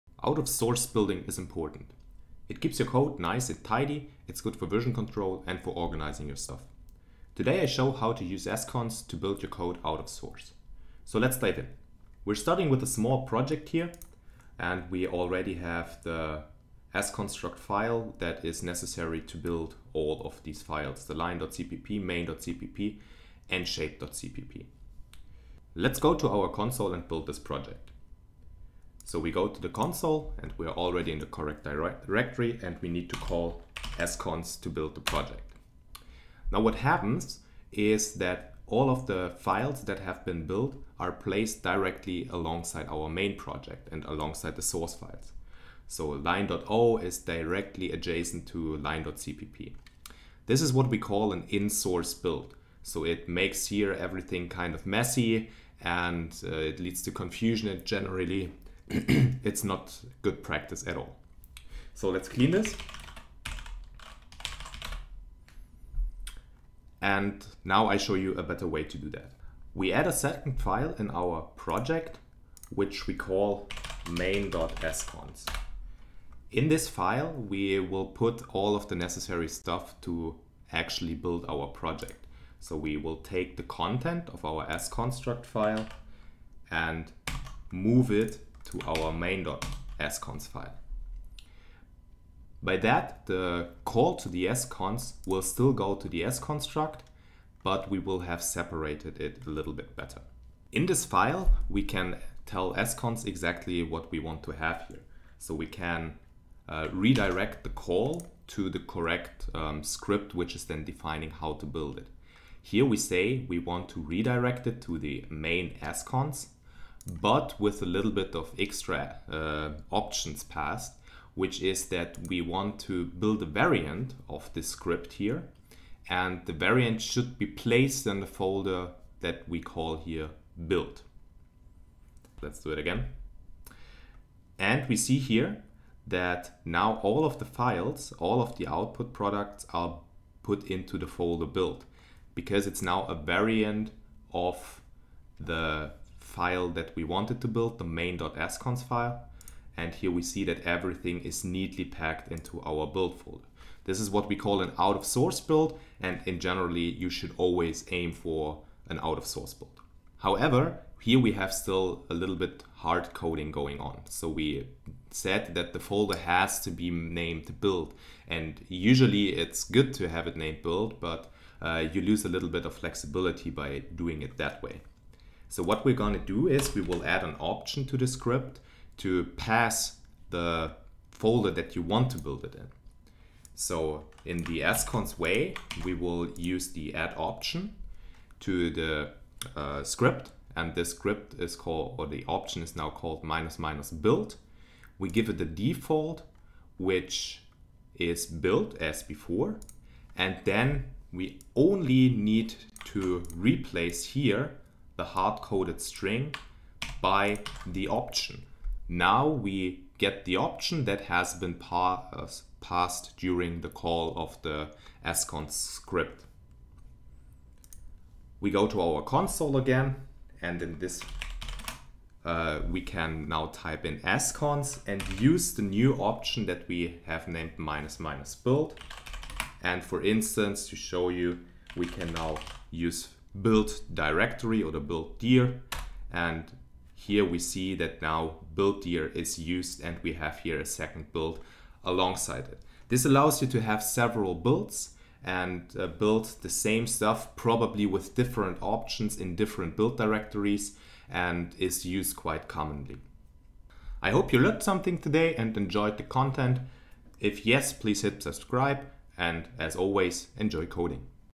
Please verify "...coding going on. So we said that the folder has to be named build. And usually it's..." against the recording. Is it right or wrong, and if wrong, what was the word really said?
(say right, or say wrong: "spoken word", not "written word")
right.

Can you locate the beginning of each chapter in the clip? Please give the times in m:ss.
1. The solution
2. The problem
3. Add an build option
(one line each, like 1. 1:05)
1. 1:06
2. 0:10
3. 2:39.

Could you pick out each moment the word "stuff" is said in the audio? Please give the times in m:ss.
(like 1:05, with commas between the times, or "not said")
0:06, 1:19, 4:06.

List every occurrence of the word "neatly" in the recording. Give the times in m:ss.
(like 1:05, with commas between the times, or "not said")
2:31.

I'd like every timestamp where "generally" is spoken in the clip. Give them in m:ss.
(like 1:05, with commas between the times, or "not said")
0:57, 2:36.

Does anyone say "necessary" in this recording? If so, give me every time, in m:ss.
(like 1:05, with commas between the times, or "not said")
0:18, 1:18.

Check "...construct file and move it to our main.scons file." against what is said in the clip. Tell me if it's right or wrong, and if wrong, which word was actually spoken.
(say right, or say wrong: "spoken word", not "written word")
right.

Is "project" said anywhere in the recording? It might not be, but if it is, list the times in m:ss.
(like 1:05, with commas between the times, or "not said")
0:13, 0:27, 0:35, 0:43, 1:11, 1:21.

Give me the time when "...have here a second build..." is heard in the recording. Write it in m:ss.
4:00.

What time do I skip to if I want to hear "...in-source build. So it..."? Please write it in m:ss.
0:51.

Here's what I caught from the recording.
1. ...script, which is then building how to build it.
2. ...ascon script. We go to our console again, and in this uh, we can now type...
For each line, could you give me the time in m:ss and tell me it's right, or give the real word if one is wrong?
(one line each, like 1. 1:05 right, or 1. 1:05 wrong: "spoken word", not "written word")
1. 1:49 wrong: "defining", not "building"
2. 3:35 right.